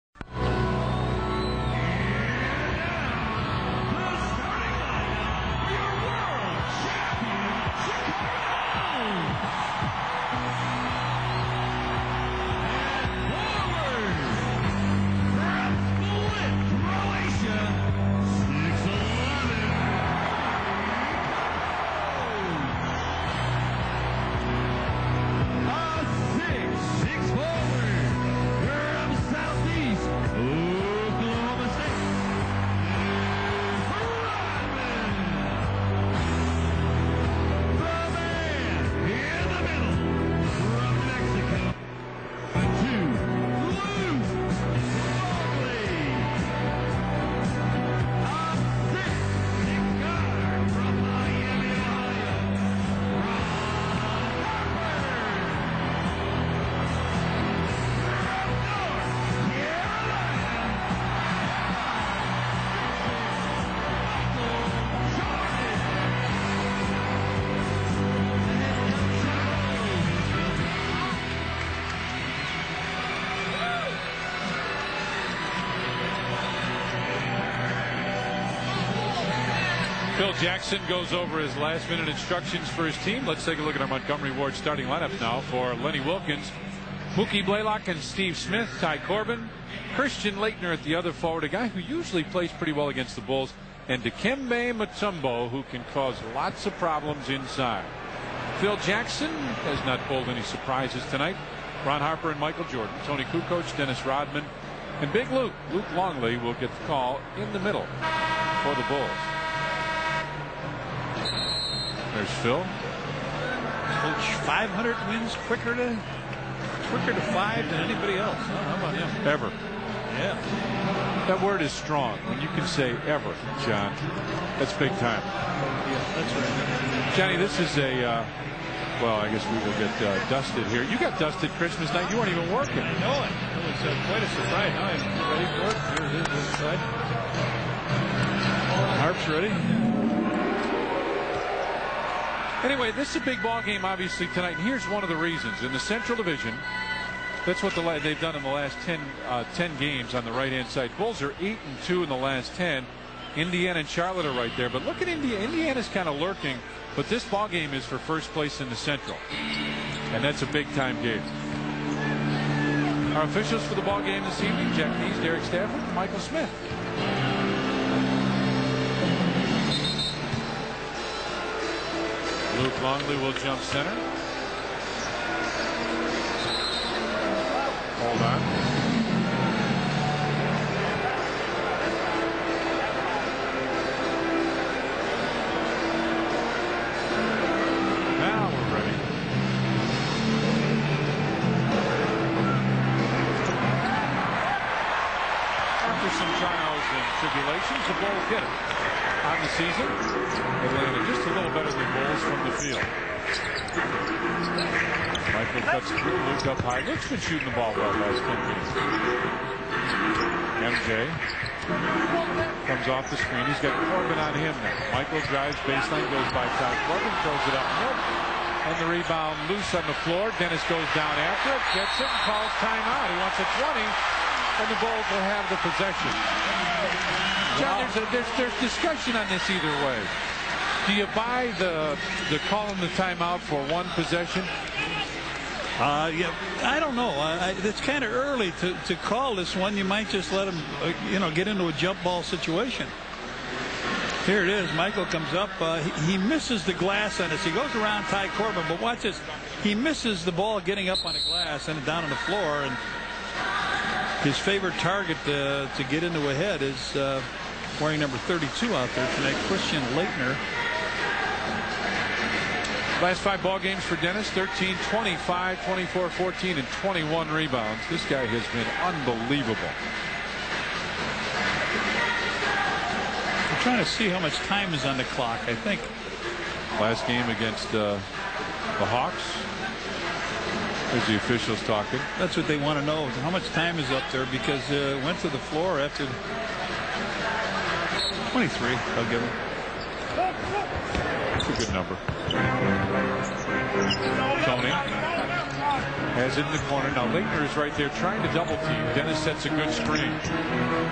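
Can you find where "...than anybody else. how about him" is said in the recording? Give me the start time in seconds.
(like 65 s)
117 s.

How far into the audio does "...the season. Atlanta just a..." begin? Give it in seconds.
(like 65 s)
199 s.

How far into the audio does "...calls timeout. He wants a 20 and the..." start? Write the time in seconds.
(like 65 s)
222 s.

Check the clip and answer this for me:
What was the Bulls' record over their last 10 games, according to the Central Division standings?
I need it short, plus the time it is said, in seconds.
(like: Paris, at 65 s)
8 and 2, at 151 s.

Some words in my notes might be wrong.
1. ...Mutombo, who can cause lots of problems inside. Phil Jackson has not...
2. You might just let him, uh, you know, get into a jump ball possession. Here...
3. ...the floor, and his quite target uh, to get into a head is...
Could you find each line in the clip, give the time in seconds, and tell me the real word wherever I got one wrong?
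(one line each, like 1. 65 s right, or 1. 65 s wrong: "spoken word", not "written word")
1. 94 s right
2. 239 s wrong: "situation", not "possession"
3. 252 s wrong: "favorite", not "quite".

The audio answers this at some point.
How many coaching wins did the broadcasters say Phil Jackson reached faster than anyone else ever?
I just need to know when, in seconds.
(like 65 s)
114 s.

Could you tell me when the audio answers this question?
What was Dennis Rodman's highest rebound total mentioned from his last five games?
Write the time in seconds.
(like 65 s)
264 s.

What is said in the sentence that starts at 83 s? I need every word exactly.
Let's take a look at our Montgomery Ward starting lineup now for Lenny Wilkens.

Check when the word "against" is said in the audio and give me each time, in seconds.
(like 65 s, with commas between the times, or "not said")
92 s, 277 s.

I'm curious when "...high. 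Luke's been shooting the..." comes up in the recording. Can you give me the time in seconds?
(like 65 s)
206 s.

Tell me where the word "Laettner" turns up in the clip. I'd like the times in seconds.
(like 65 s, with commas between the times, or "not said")
90 s, 259 s.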